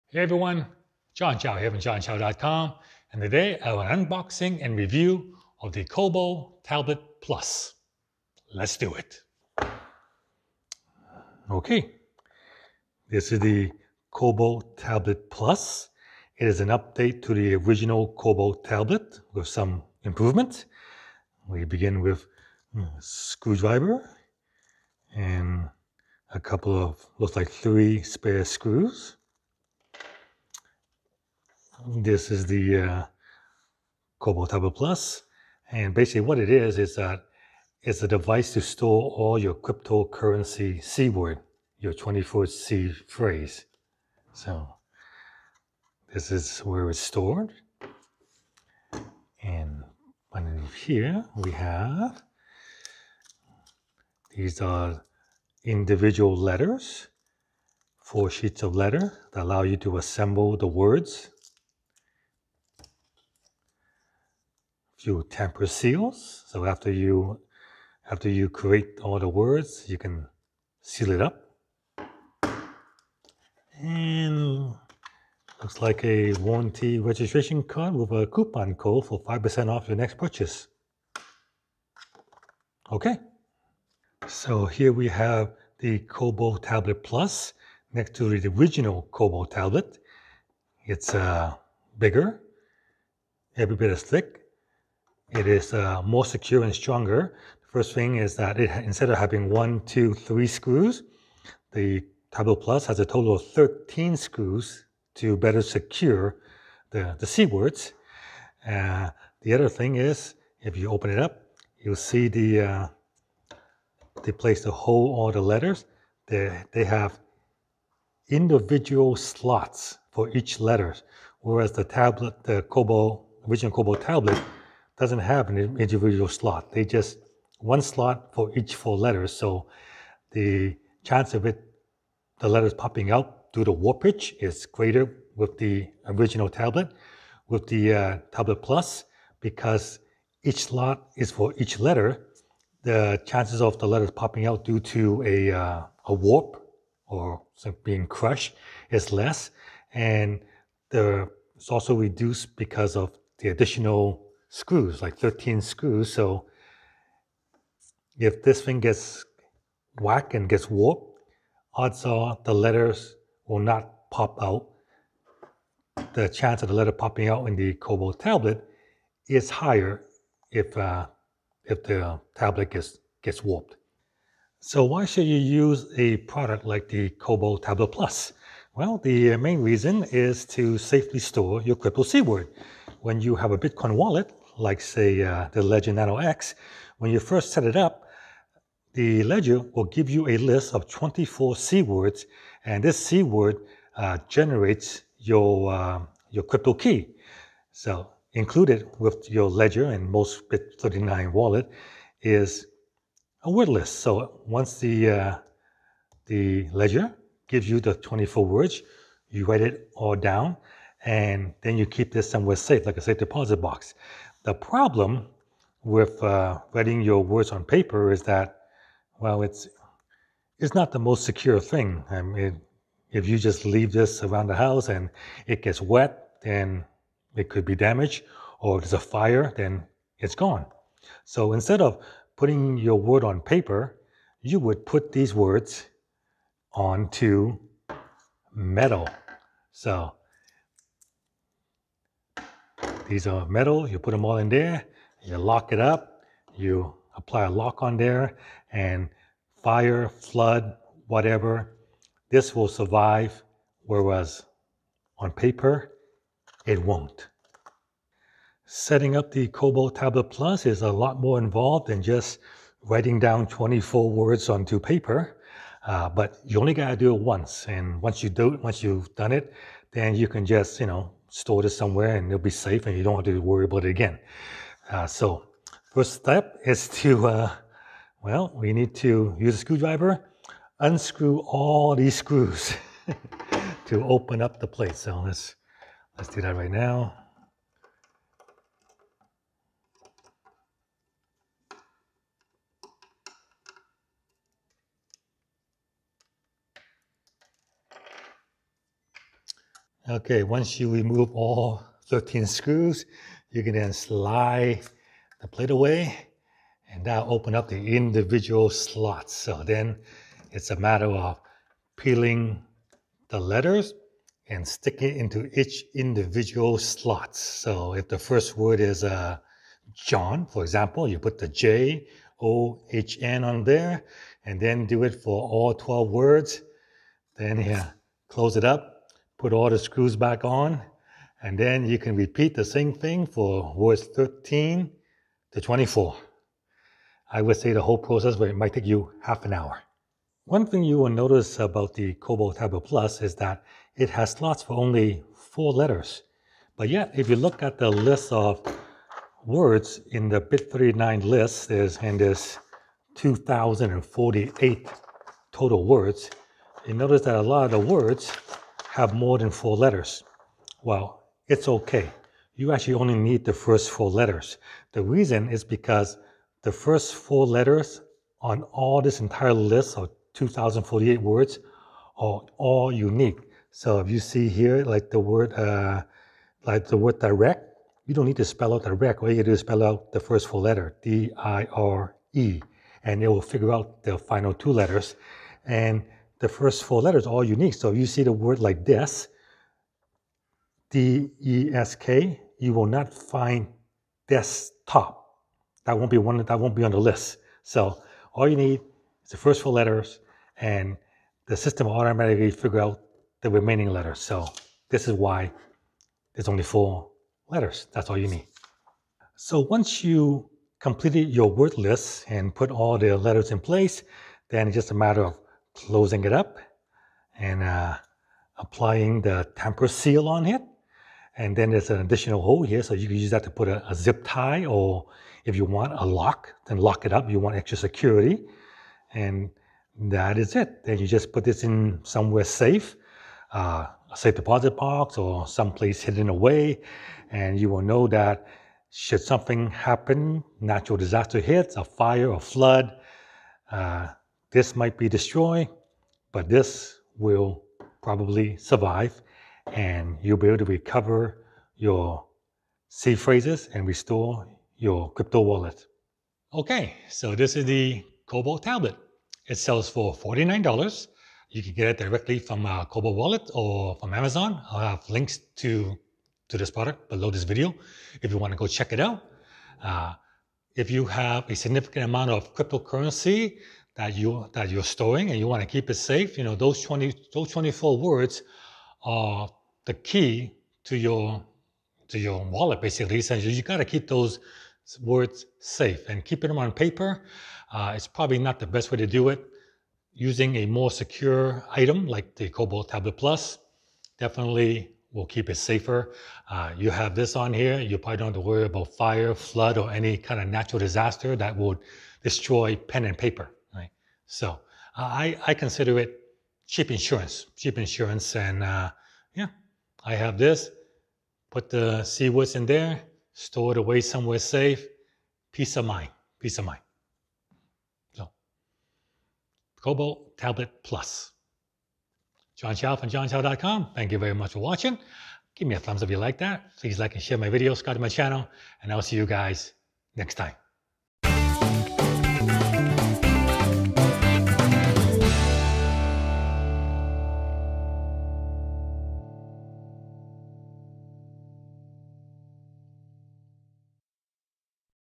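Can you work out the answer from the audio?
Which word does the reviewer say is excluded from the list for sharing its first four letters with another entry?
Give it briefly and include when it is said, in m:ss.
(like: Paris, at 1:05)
Desktop, at 6:34.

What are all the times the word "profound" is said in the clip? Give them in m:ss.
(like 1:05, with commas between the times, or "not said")
not said.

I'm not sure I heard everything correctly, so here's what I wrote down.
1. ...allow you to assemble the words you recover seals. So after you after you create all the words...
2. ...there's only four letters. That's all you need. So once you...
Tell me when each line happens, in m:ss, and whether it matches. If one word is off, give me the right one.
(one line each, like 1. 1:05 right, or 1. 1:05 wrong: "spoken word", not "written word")
1. 0:59 wrong: "temper", not "recover"
2. 6:46 right.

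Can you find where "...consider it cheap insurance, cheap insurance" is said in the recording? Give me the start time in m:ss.
8:25.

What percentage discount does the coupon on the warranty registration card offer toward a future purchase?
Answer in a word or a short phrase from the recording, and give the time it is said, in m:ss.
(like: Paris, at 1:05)
5%, at 1:19.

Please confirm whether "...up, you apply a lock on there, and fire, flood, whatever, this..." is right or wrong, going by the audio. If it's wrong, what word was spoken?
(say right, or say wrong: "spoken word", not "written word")
right.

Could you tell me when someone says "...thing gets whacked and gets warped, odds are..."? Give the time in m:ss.
2:38.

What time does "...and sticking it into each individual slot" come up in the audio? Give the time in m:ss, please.
5:14.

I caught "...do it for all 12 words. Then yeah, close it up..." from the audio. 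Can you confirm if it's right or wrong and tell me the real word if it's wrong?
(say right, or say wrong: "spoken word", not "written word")
right.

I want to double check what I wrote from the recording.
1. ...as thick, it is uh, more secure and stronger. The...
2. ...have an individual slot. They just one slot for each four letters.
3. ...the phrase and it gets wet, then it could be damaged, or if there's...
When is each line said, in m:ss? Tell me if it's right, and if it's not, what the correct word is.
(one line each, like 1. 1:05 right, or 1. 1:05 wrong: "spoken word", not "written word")
1. 1:33 right
2. 2:05 right
3. 3:44 wrong: "house", not "phrase".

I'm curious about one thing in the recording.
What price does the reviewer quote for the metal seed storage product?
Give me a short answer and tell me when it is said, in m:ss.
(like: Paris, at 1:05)
$49, at 7:40.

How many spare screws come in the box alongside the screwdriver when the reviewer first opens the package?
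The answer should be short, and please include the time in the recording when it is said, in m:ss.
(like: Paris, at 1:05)
3, at 0:27.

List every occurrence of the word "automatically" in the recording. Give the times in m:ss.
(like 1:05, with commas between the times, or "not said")
6:41.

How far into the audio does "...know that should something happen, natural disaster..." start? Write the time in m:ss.
7:17.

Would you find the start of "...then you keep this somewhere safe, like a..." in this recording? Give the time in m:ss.
3:31.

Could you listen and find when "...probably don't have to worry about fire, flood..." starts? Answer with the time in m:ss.
8:17.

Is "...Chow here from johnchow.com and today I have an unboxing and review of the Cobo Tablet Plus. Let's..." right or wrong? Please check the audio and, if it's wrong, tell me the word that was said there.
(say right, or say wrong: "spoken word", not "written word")
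right.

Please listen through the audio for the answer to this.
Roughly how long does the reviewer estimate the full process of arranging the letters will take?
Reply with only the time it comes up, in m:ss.
5:39.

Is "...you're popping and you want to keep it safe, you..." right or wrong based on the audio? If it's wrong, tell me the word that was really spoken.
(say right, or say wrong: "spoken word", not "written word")
wrong: "storing", not "popping".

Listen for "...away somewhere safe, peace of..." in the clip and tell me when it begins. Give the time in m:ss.
8:33.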